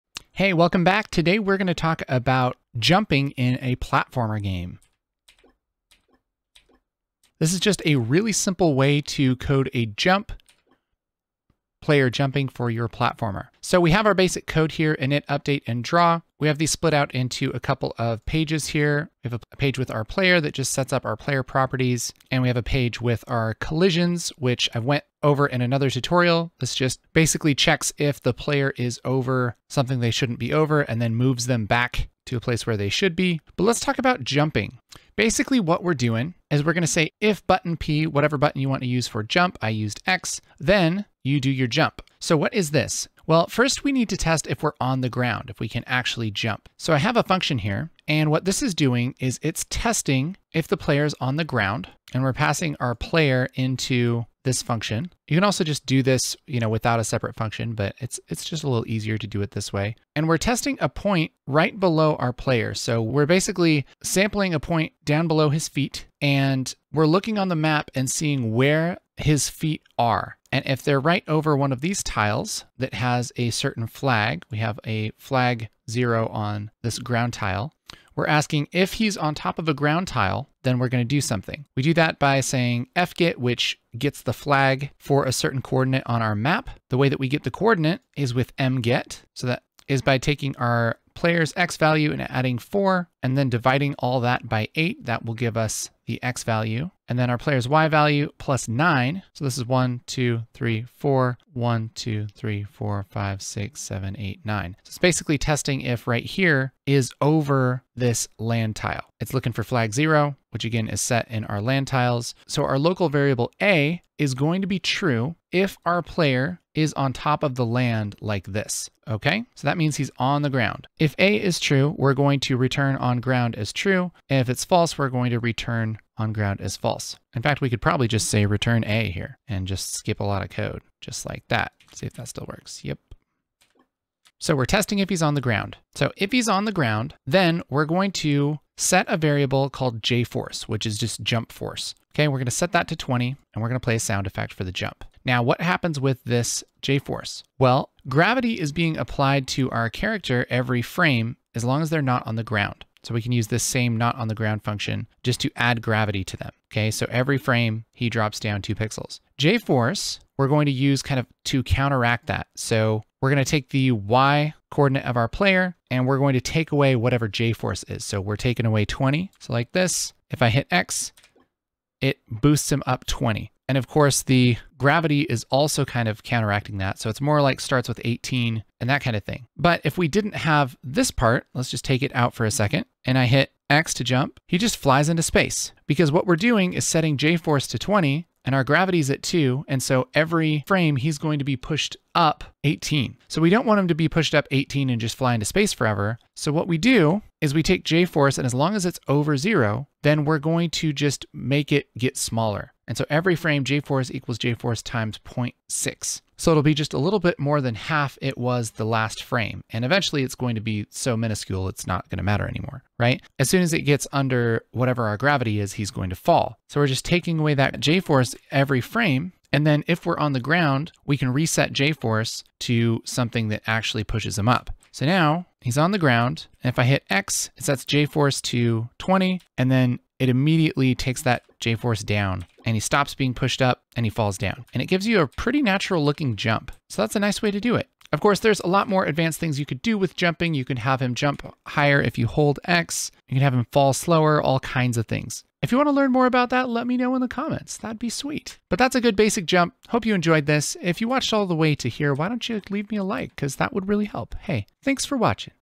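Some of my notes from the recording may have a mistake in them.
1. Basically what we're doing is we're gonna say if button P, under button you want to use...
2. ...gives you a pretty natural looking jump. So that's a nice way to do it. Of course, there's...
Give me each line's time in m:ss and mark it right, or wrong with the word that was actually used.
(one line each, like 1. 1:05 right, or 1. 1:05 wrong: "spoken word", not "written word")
1. 0:35 wrong: "whatever", not "under"
2. 3:54 right.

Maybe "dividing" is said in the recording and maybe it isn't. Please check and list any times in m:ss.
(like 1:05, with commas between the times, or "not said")
1:33.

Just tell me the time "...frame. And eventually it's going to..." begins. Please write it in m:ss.
3:29.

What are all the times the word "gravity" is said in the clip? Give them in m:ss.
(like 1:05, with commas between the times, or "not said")
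2:28, 2:35, 2:54, 3:08, 3:35.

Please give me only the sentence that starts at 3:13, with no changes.
So we don't want him to be pushed up 18 and just fly into space forever.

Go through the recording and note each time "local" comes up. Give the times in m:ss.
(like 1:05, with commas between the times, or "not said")
1:52.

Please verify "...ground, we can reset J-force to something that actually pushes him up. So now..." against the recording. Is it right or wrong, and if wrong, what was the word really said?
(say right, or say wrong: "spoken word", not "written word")
right.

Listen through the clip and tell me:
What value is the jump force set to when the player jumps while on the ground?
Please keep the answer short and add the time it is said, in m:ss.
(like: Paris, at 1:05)
20, at 2:22.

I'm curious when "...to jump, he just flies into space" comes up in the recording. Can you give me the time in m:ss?
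3:03.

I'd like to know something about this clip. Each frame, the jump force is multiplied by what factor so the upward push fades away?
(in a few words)
0.6.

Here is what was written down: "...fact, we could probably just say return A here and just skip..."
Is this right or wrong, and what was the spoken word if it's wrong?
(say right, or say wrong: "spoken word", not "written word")
right.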